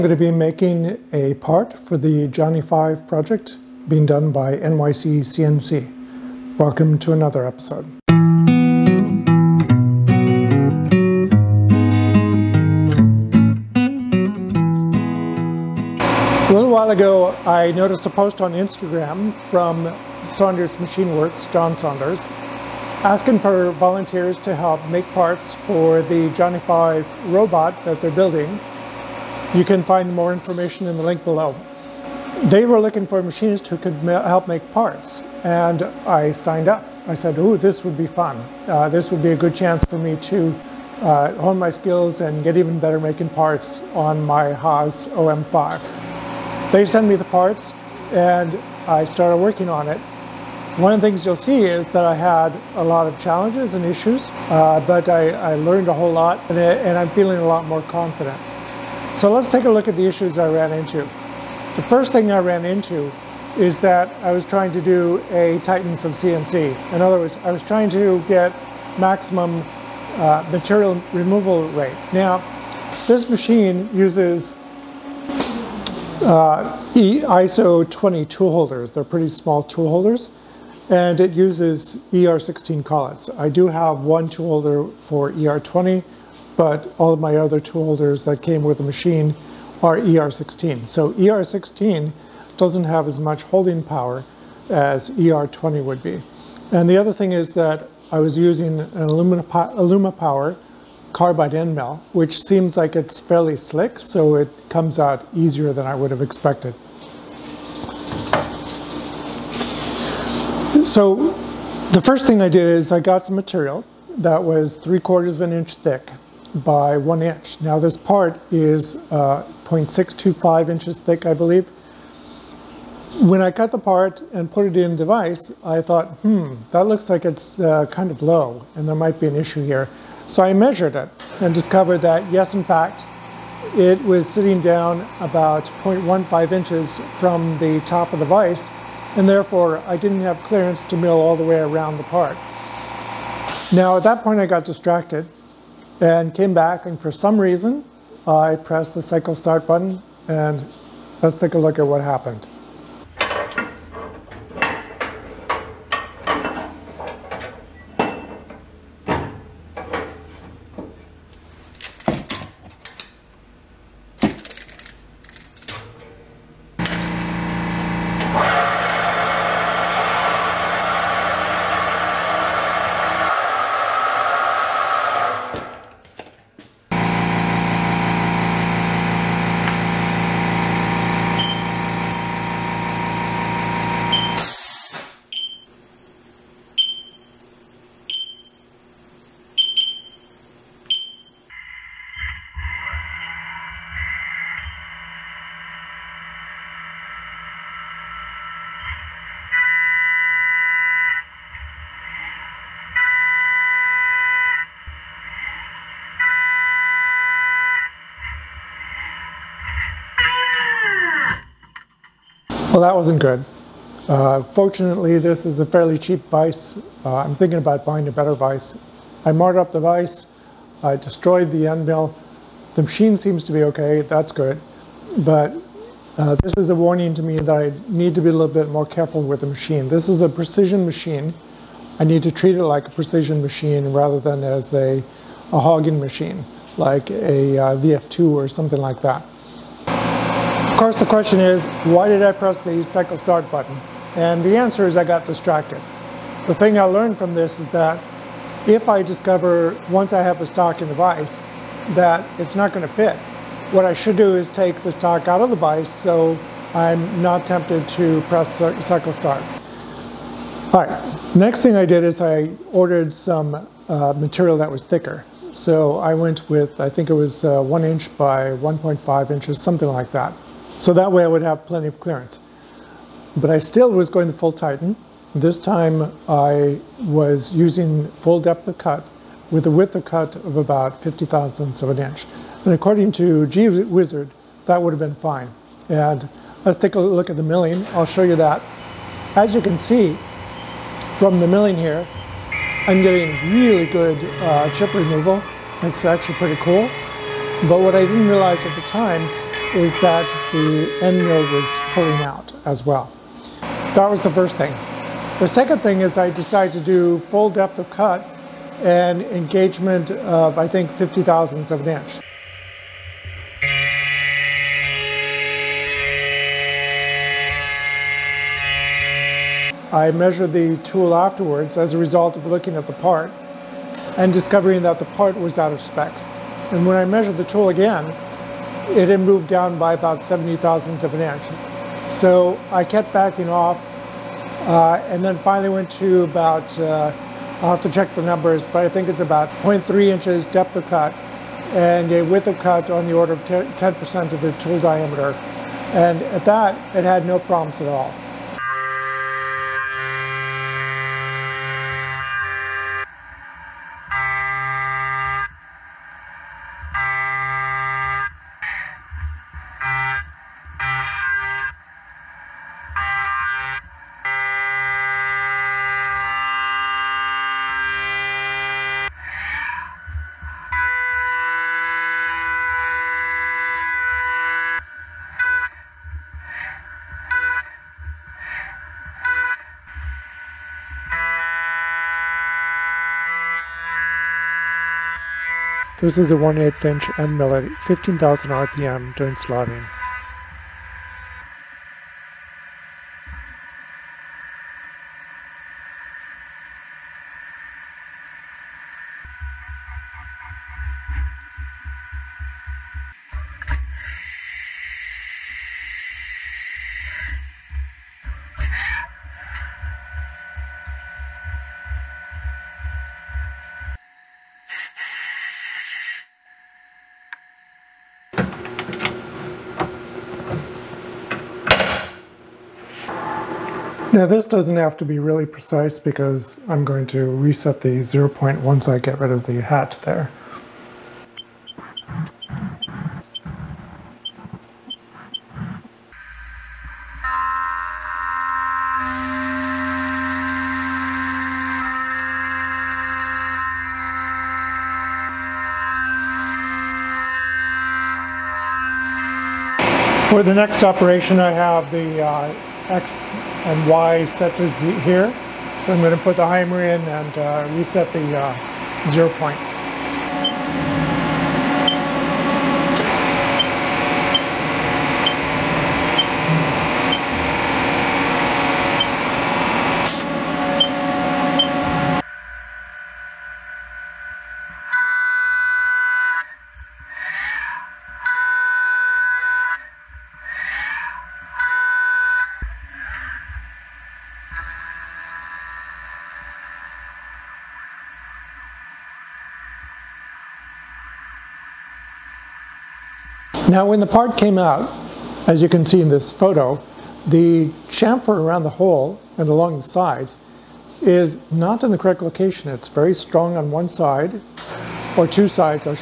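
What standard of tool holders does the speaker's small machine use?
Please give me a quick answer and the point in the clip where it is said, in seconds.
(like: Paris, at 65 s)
ISO 20, at 76 s.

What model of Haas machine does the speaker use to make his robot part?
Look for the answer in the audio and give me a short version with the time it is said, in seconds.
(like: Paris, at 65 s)
OM5, at 45 s.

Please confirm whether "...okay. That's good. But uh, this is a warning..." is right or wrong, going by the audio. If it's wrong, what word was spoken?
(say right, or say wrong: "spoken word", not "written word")
right.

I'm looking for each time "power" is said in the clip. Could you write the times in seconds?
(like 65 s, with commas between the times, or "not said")
93 s, 100 s.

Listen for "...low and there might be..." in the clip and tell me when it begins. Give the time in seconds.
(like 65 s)
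128 s.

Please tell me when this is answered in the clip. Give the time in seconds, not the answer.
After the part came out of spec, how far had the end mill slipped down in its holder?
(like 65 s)
330 s.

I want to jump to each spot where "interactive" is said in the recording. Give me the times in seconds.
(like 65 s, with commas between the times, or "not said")
not said.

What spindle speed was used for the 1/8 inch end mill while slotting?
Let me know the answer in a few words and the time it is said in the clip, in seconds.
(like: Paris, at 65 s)
15,000 RPM, at 387 s.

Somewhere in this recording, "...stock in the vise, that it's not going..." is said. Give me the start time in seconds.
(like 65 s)
250 s.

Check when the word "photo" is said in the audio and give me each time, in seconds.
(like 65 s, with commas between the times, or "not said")
496 s.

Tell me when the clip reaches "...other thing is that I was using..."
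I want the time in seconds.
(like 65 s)
96 s.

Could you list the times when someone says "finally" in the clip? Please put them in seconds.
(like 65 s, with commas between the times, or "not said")
335 s.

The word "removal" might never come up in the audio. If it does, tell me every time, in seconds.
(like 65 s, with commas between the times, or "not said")
71 s, 294 s.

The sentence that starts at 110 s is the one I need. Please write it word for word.
So the first thing I did is I got some material that was three quarters of an inch thick by one inch.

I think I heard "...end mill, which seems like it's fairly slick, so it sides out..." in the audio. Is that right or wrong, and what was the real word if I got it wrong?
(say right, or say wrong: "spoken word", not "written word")
wrong: "comes", not "sides".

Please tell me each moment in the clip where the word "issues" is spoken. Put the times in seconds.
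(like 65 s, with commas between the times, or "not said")
53 s, 60 s, 129 s.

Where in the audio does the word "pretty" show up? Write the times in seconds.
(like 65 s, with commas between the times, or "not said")
79 s, 296 s.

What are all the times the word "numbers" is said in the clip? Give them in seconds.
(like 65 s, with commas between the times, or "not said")
338 s.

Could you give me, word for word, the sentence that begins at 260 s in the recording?
All right, next thing I did is I ordered some uh, material that was thicker.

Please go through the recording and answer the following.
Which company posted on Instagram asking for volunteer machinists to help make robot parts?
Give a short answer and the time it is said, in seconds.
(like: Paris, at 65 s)
Saunders Machine Works, at 20 s.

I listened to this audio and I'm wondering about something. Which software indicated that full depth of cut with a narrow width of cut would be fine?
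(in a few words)
G Wizard.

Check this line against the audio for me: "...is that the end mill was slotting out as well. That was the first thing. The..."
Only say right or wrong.
wrong.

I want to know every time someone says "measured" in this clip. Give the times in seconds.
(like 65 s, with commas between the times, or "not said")
130 s, 320 s, 327 s.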